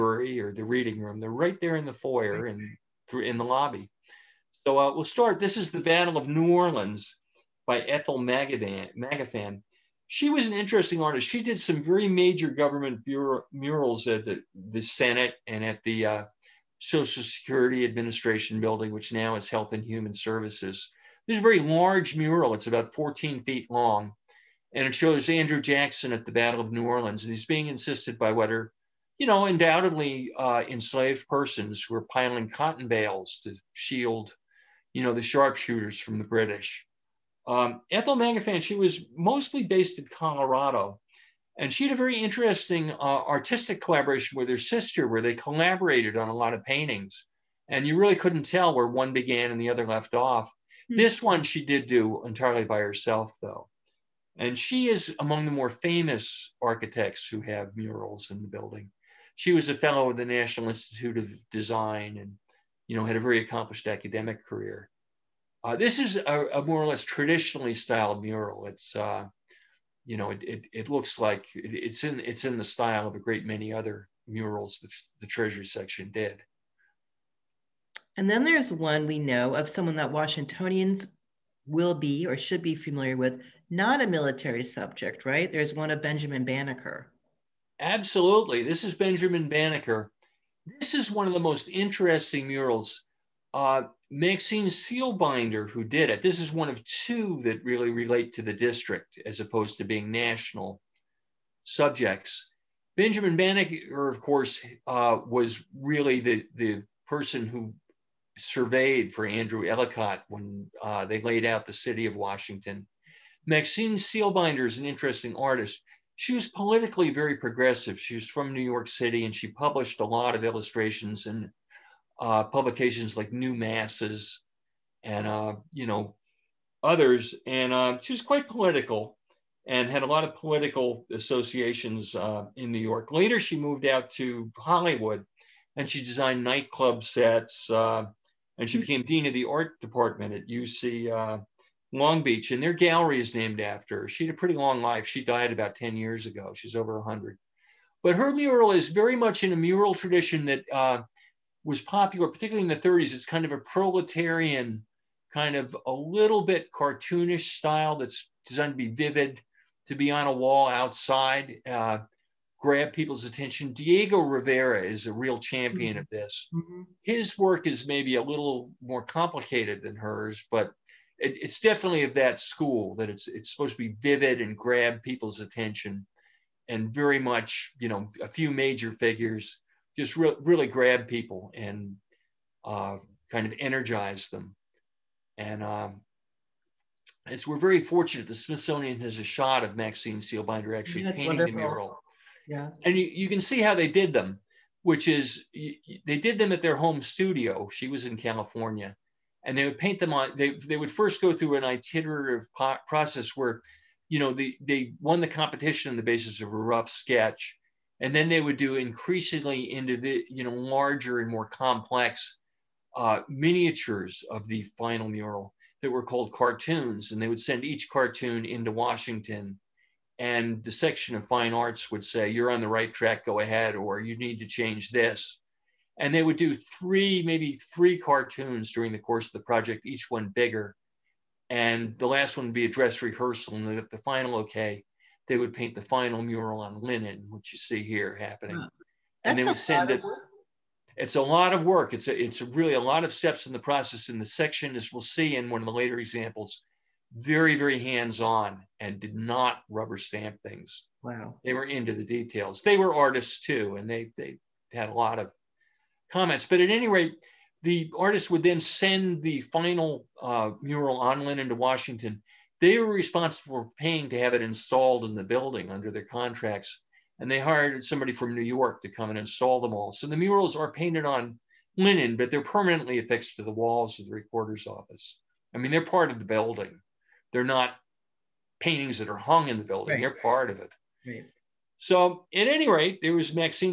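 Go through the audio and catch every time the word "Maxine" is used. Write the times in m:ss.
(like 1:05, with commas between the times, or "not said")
1:34, 1:53, 3:09.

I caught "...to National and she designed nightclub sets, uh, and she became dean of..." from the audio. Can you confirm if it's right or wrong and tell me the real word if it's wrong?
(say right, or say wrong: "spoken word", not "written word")
wrong: "Hollywood", not "National".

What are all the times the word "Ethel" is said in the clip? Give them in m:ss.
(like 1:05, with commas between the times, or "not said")
0:07, 0:37.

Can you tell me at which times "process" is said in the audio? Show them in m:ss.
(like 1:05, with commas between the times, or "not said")
3:22, 4:03.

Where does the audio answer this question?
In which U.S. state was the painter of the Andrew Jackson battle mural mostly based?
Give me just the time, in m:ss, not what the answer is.
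0:40.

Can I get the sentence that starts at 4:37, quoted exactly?
They're not paintings that are hung in the building.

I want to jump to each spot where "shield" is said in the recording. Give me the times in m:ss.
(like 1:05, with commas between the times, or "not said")
0:33.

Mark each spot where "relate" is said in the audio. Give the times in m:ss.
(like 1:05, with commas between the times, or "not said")
1:37.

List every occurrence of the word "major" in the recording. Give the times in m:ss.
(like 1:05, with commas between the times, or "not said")
0:12, 2:58.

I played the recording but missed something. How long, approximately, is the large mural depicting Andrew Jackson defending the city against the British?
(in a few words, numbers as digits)
14 feet.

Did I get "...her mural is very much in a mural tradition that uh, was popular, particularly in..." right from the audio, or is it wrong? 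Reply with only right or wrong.
right.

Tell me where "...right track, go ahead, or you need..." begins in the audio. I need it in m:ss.
3:42.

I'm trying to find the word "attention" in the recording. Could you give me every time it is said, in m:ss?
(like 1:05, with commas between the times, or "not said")
2:43, 2:55.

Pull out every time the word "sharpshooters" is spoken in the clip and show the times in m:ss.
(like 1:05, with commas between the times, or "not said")
0:35.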